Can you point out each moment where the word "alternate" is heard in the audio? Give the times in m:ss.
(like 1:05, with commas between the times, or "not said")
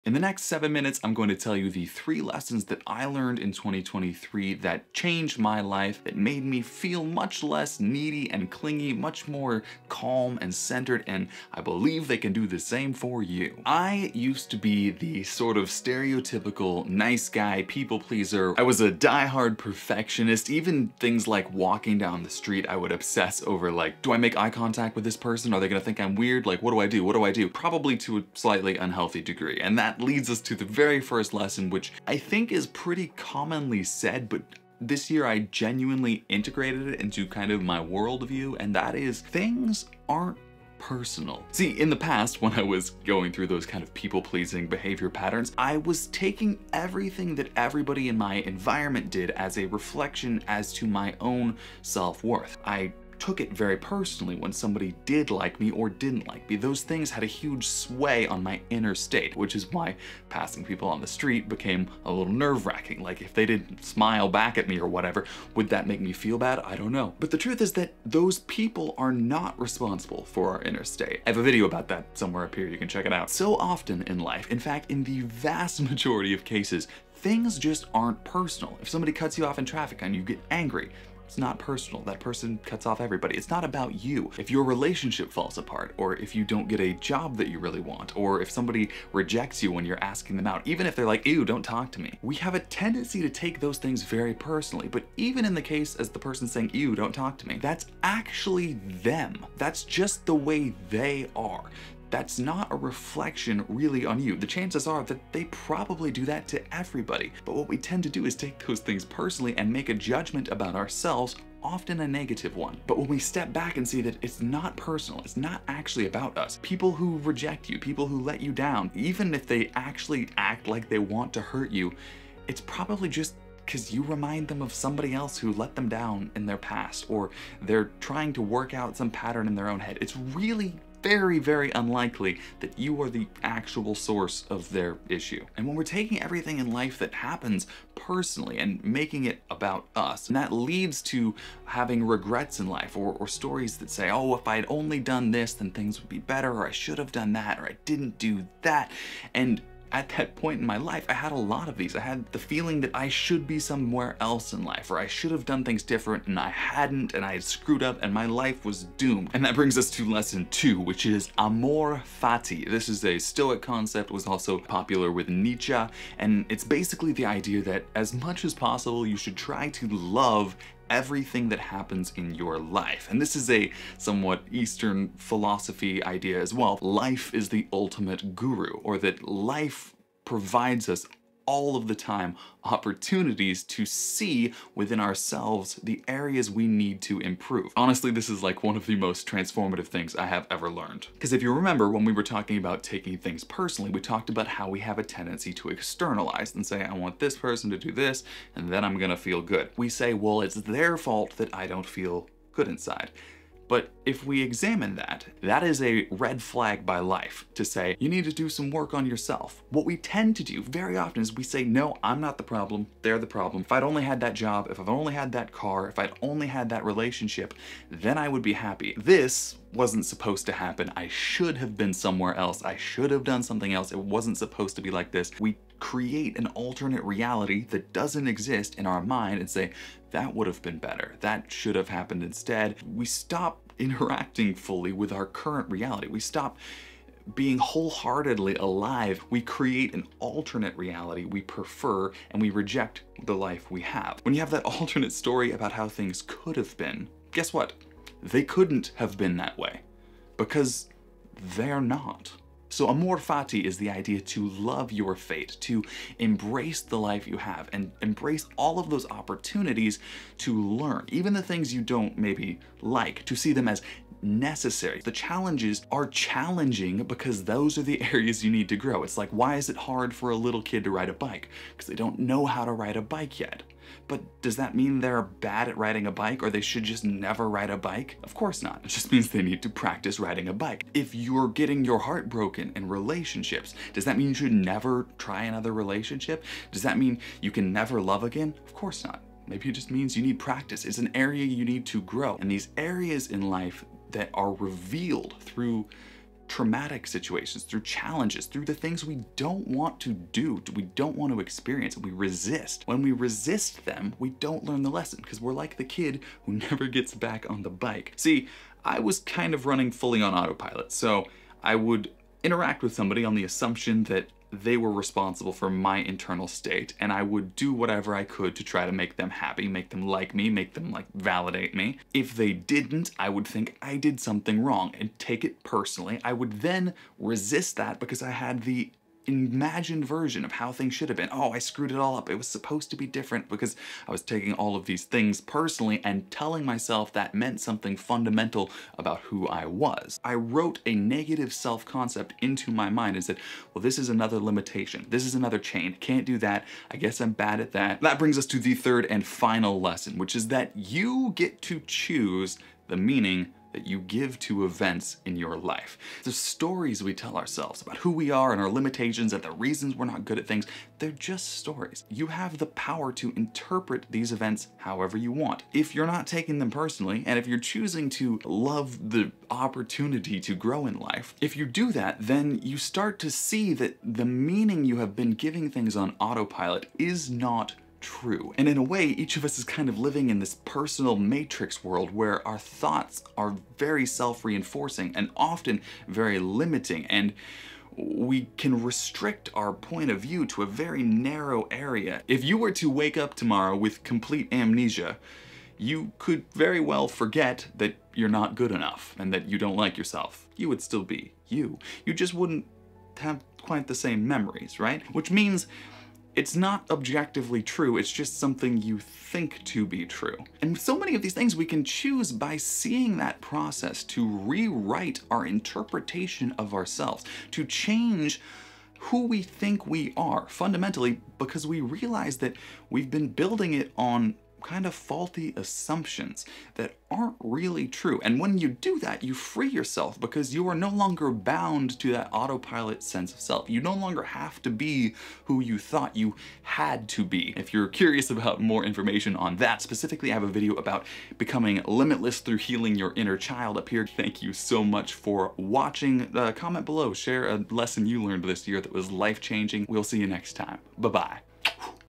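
3:46, 4:00, 4:04.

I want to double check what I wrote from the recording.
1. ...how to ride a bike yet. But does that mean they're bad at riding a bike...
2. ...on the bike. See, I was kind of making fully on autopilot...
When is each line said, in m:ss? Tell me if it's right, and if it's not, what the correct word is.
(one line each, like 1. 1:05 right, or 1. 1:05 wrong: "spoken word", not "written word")
1. 4:32 right
2. 5:07 wrong: "running", not "making".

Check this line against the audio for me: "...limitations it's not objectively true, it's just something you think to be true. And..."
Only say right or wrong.
wrong.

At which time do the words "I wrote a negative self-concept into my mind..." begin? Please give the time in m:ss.
5:40.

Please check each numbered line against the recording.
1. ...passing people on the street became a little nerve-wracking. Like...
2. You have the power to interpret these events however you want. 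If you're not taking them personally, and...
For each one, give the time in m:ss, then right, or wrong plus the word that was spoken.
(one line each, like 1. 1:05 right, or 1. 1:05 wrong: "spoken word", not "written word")
1. 1:00 right
2. 6:02 right.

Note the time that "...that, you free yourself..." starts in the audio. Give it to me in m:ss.
7:08.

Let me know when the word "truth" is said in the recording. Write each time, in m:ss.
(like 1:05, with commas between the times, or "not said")
1:07.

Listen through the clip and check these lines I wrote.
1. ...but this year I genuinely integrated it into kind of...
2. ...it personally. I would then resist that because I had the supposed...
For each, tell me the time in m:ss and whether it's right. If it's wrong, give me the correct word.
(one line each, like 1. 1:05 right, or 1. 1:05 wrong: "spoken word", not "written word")
1. 0:34 right
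2. 5:25 wrong: "imagined", not "supposed".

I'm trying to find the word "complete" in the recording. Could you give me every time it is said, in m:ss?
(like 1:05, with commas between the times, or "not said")
6:34.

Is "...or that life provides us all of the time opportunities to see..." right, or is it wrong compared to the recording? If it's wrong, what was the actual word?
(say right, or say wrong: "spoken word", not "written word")
right.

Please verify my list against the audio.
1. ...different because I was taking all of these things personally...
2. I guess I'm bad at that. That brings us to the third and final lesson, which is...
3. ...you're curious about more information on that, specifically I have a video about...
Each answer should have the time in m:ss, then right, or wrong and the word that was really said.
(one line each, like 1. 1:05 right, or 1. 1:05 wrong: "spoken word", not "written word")
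1. 5:33 right
2. 5:46 right
3. 7:17 right.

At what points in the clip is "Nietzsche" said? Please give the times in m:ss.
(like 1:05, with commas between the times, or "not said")
2:45.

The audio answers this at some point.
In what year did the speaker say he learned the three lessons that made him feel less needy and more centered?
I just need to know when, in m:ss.
0:03.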